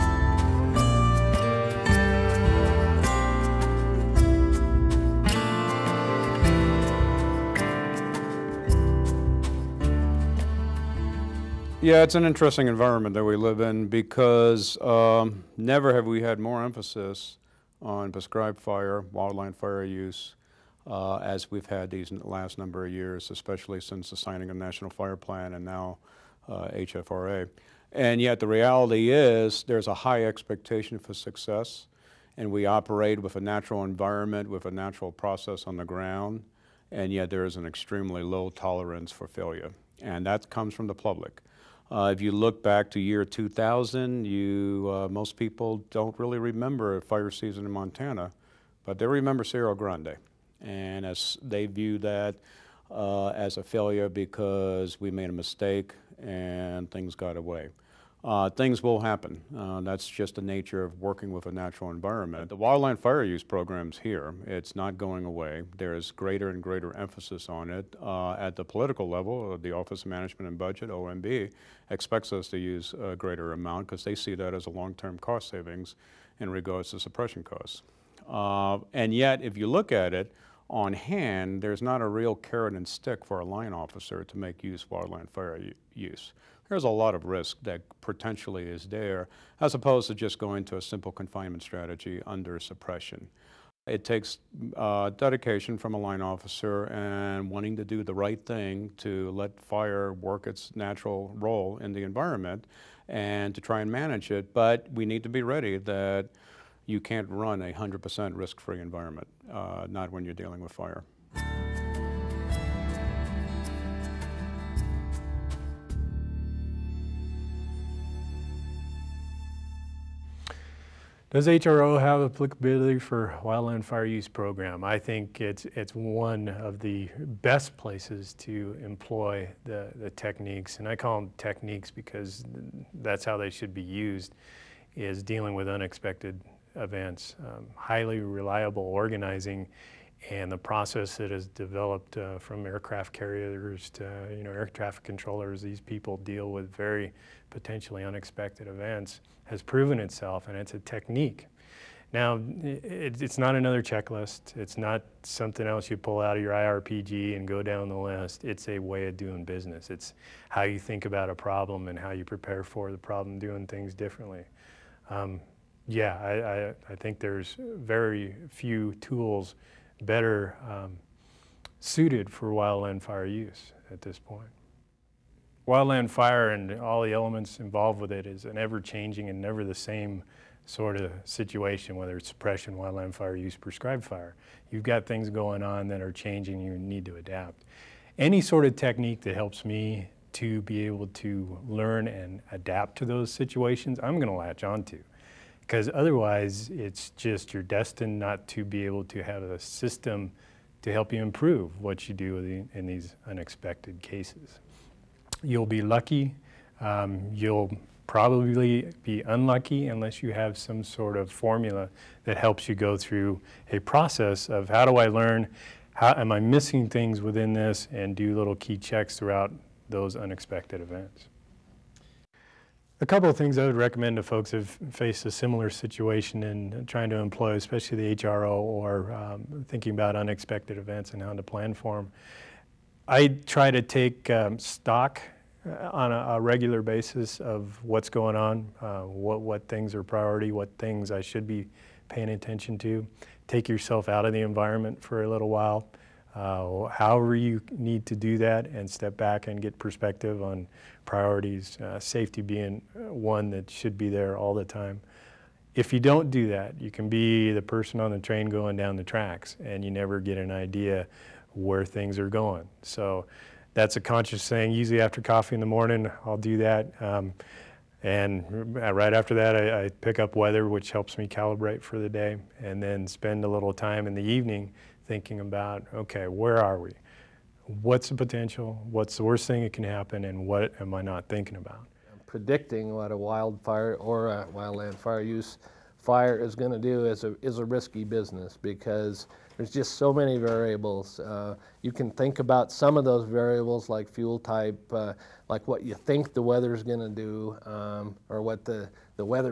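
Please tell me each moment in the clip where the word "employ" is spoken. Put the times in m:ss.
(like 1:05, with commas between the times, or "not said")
2:08, 3:47.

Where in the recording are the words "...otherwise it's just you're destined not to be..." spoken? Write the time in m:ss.
3:15.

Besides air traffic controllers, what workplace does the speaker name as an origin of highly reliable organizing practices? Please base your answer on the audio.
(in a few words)
aircraft carriers.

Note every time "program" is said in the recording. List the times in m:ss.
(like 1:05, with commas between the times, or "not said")
1:03, 2:04.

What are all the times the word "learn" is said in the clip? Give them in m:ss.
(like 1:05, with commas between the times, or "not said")
3:11, 3:35.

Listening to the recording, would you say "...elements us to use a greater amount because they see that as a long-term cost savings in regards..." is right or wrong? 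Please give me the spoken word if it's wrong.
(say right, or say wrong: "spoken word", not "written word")
wrong: "expects", not "elements".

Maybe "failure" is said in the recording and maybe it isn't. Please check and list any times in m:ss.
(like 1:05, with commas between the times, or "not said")
0:39, 0:53.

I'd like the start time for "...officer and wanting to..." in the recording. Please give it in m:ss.
1:36.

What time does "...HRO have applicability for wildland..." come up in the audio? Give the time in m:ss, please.
2:01.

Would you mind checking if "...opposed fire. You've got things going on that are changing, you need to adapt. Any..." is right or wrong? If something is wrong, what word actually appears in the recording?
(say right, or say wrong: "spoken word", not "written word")
wrong: "prescribed", not "opposed".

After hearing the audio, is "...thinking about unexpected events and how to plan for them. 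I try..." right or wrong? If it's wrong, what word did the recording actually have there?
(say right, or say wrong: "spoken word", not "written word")
right.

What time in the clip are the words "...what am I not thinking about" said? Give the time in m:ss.
4:40.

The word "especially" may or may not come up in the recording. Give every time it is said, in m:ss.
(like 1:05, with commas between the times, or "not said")
0:23, 3:47.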